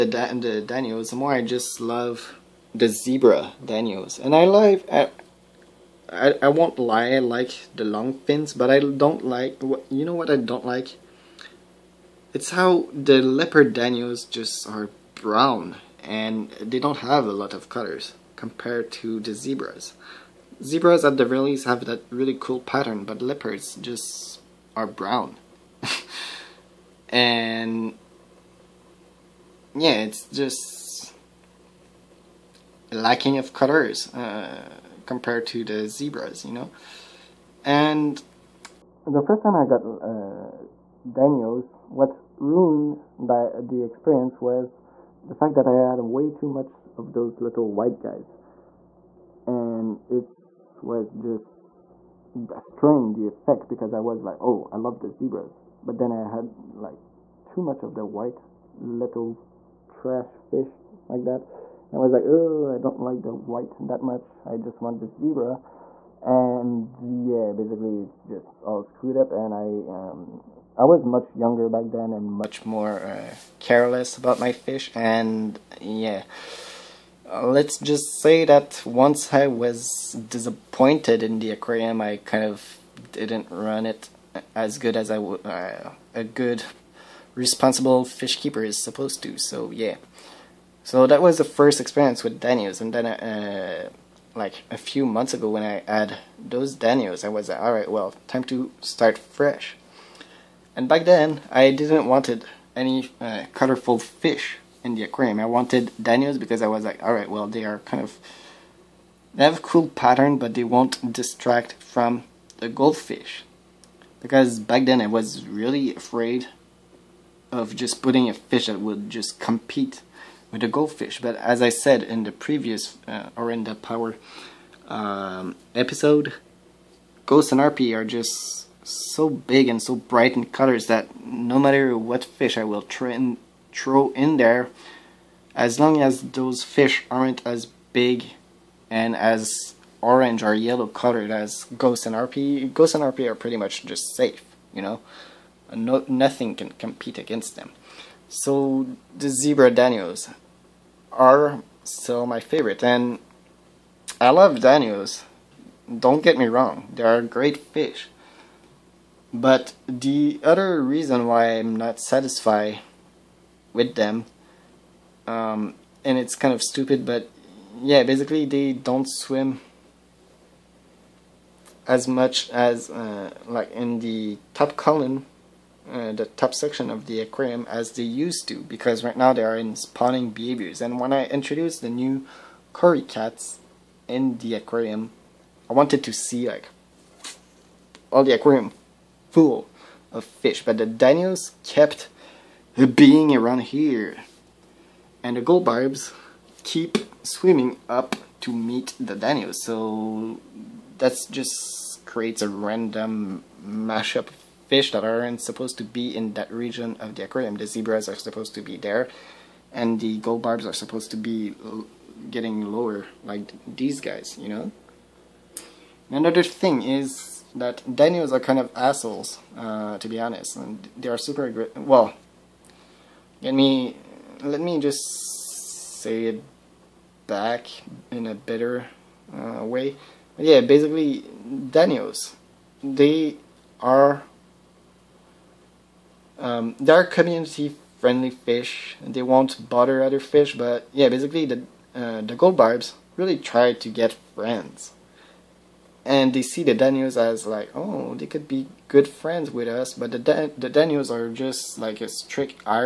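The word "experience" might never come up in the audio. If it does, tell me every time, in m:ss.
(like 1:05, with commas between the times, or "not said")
0:43, 1:31.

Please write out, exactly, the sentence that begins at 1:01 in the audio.
And I was like, oh, I don't like the white that much.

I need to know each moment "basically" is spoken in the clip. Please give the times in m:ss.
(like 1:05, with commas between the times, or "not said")
1:07, 2:48, 3:50, 4:01.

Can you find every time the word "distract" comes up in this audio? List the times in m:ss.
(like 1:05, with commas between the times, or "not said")
1:51.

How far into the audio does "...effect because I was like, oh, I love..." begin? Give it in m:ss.
0:53.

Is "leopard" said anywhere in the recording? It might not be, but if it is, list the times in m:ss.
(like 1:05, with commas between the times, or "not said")
0:13, 0:23.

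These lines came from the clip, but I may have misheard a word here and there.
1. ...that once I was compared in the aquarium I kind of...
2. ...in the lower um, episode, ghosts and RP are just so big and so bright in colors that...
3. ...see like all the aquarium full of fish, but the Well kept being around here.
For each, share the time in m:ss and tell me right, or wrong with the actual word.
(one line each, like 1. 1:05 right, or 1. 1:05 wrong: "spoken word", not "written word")
1. 1:18 wrong: "disappointed", not "compared"
2. 2:03 wrong: "power", not "lower"
3. 3:06 wrong: "Danios", not "Well".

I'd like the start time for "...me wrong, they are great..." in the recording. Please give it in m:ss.
2:36.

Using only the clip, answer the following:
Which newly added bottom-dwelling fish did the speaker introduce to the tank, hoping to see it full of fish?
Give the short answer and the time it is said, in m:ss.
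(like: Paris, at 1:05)
Cory cats, at 3:02.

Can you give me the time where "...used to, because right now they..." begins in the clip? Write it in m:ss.
2:58.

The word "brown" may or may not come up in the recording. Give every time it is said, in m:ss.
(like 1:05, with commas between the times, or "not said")
0:15, 0:24.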